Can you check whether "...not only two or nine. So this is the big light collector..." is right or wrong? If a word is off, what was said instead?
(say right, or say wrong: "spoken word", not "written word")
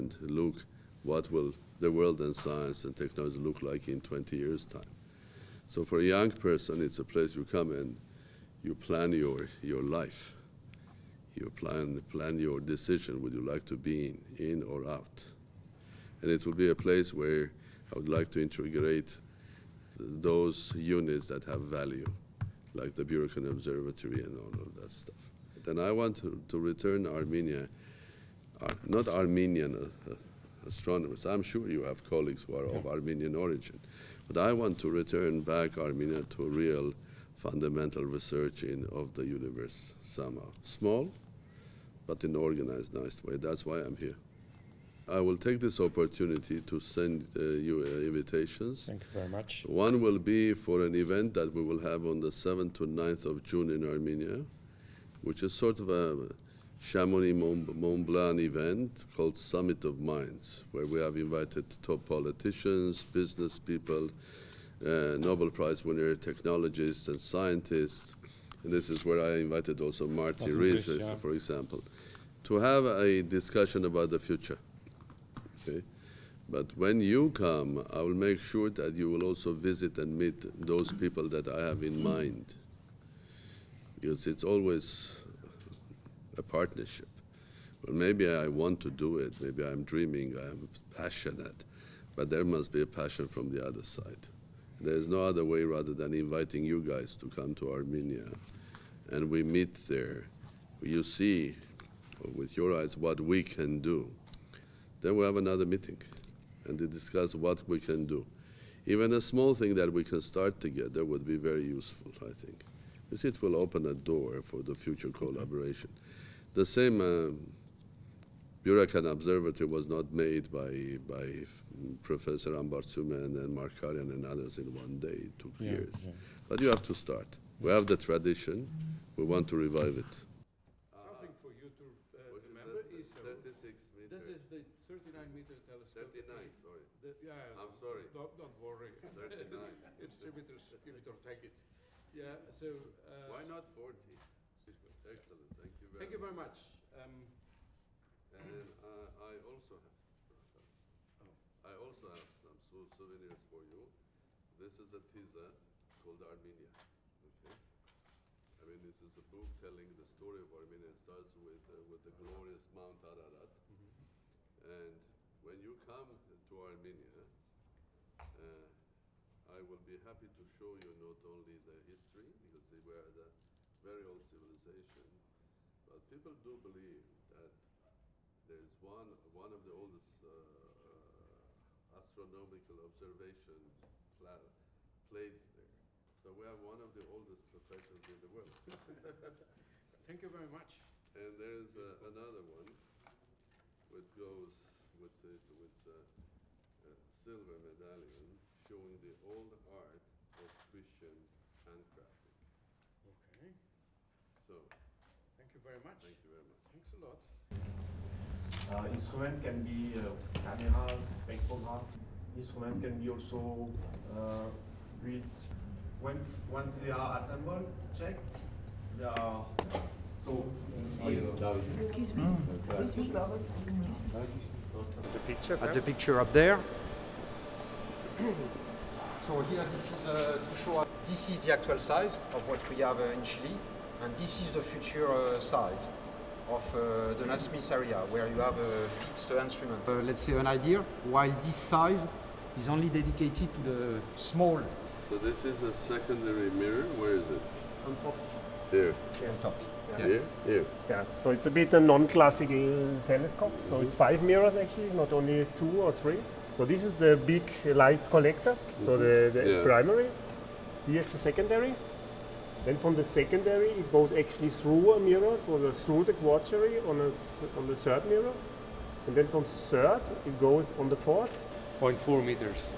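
wrong: "three", not "nine".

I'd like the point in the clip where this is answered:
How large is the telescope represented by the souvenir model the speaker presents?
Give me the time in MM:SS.
02:14.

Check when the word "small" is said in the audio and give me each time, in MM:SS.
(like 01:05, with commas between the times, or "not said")
00:40, 01:49, 04:04.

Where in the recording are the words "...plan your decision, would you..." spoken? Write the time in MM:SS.
00:12.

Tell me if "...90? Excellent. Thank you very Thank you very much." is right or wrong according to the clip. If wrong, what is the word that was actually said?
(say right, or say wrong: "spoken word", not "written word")
wrong: "40", not "90".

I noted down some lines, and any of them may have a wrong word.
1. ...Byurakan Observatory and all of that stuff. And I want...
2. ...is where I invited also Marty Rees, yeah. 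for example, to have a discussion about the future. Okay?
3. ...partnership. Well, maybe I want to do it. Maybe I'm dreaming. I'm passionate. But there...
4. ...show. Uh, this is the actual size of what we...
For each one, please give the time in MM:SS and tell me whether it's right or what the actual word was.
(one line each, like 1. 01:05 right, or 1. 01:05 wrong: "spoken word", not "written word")
1. 00:23 right
2. 01:08 right
3. 01:26 right
4. 03:50 right.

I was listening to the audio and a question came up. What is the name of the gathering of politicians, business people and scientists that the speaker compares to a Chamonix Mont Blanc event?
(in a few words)
Summit of Minds.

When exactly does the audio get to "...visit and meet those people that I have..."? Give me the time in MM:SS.
01:19.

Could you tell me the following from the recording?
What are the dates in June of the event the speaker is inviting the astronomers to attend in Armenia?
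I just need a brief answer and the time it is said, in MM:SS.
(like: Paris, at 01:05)
7th to 9th, at 00:52.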